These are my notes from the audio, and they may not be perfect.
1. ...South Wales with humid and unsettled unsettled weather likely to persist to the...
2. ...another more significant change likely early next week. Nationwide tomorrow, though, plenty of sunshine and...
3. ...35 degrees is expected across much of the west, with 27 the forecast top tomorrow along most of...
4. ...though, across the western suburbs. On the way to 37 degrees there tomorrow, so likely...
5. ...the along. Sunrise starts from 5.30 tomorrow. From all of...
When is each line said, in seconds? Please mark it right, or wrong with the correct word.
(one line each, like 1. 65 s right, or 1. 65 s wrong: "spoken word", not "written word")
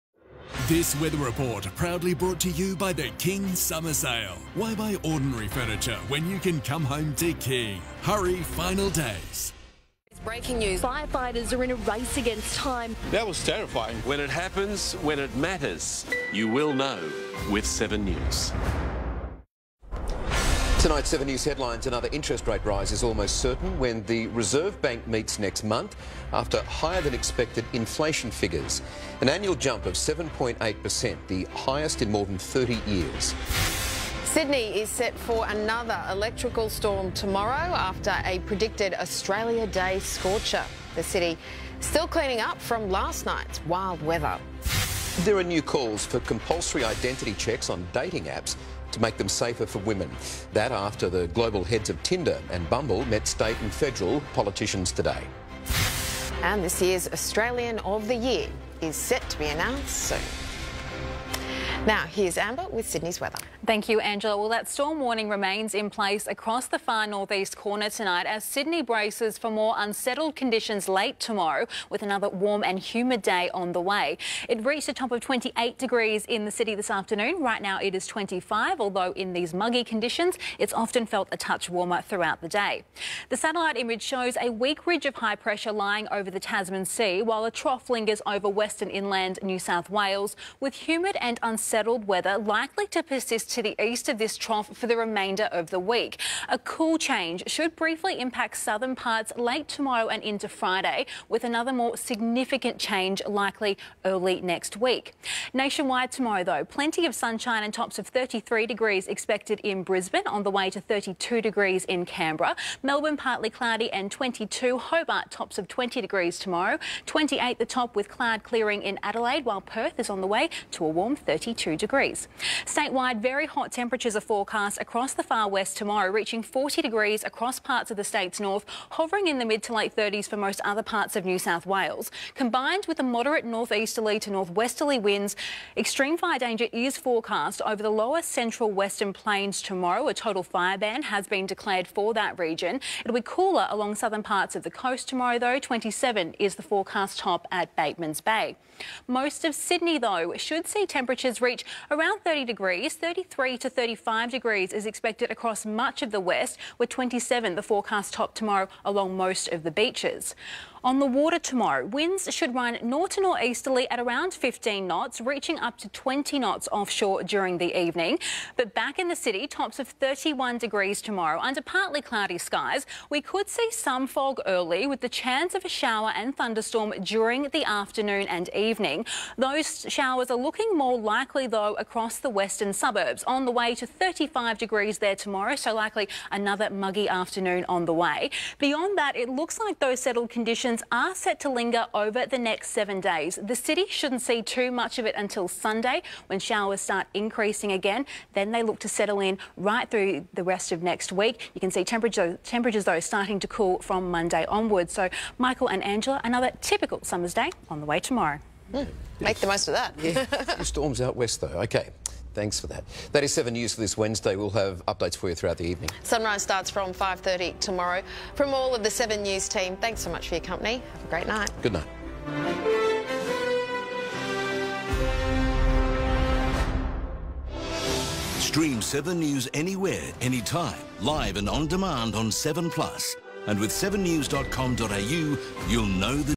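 1. 89 s right
2. 101 s right
3. 153 s right
4. 181 s wrong: "35", not "37"
5. 215 s wrong: "evening", not "along".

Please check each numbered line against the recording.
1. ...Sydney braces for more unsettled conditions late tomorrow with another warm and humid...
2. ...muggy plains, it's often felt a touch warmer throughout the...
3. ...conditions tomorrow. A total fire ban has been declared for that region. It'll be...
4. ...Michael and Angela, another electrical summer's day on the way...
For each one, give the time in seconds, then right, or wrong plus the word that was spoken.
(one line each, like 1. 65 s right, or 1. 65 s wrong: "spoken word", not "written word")
1. 68 s right
2. 79 s wrong: "conditions", not "plains"
3. 139 s wrong: "plains", not "conditions"
4. 205 s wrong: "typical", not "electrical".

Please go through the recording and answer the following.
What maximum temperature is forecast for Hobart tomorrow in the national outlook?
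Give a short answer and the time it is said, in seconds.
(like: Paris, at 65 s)
20 degrees, at 115 s.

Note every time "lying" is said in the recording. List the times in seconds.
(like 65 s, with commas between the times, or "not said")
85 s.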